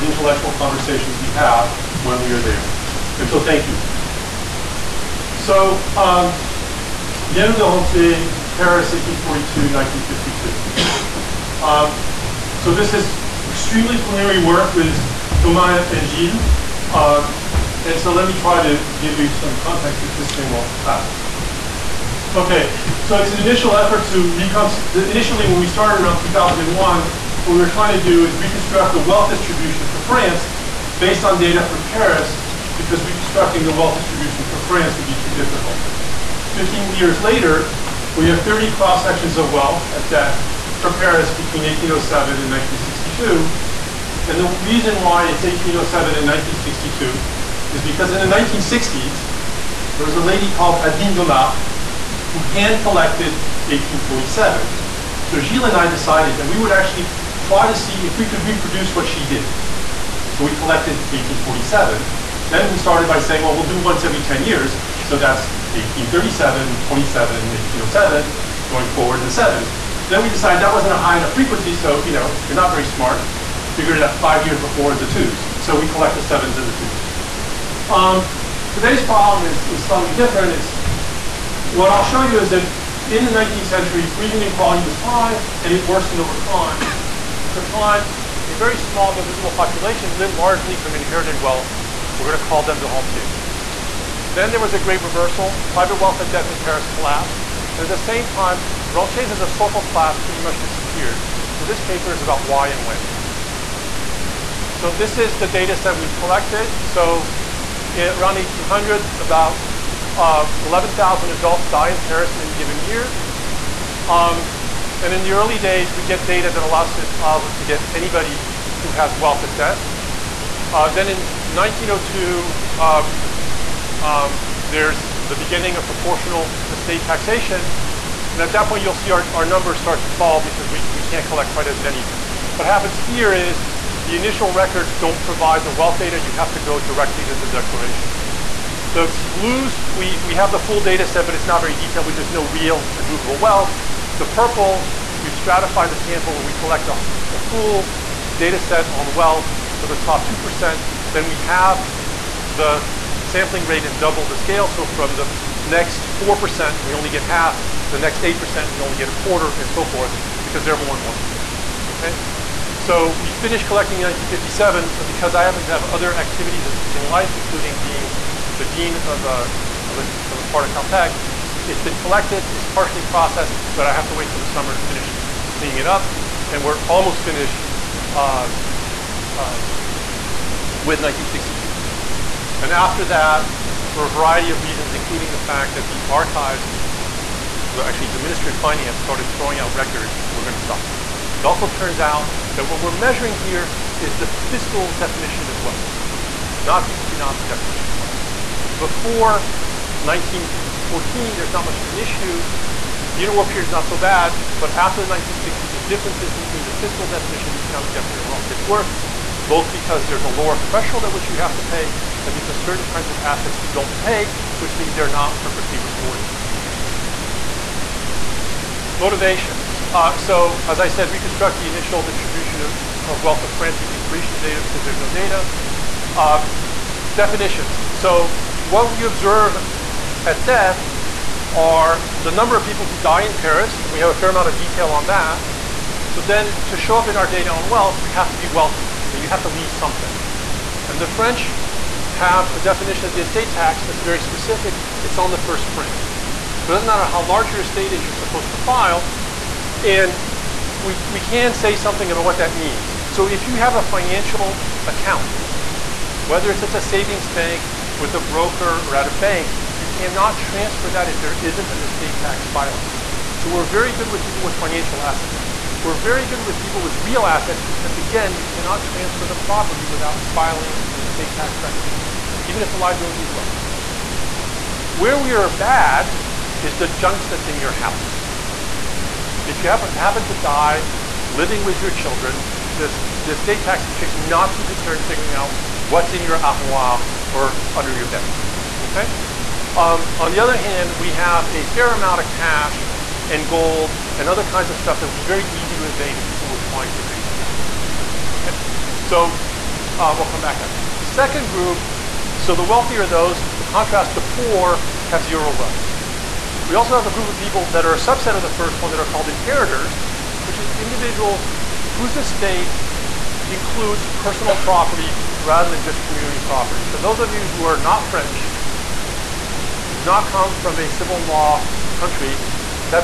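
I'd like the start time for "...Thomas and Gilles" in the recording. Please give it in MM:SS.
00:15.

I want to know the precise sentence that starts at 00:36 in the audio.
15 years later, we have 30 cross-sections of wealth at death for Paris between 1807 and 1962.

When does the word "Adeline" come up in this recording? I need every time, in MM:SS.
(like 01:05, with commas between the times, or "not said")
00:50.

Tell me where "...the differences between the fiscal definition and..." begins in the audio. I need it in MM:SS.
03:25.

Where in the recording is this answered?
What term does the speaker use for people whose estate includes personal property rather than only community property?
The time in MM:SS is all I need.
05:09.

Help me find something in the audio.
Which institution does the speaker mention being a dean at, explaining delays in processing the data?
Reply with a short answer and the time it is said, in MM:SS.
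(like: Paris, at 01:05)
Caltech, at 02:50.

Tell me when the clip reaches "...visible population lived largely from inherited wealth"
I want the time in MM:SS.
01:29.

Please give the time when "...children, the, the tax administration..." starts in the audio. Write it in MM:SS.
04:41.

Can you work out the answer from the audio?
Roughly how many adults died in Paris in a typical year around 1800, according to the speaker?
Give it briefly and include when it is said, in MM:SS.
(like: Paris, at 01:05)
11,000, at 01:50.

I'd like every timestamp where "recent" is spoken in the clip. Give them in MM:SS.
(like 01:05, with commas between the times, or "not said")
not said.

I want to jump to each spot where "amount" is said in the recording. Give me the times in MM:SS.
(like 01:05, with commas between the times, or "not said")
03:54, 04:51.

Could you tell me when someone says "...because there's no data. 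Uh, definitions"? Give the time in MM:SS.
03:44.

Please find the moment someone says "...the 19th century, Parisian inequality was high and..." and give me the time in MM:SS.
01:23.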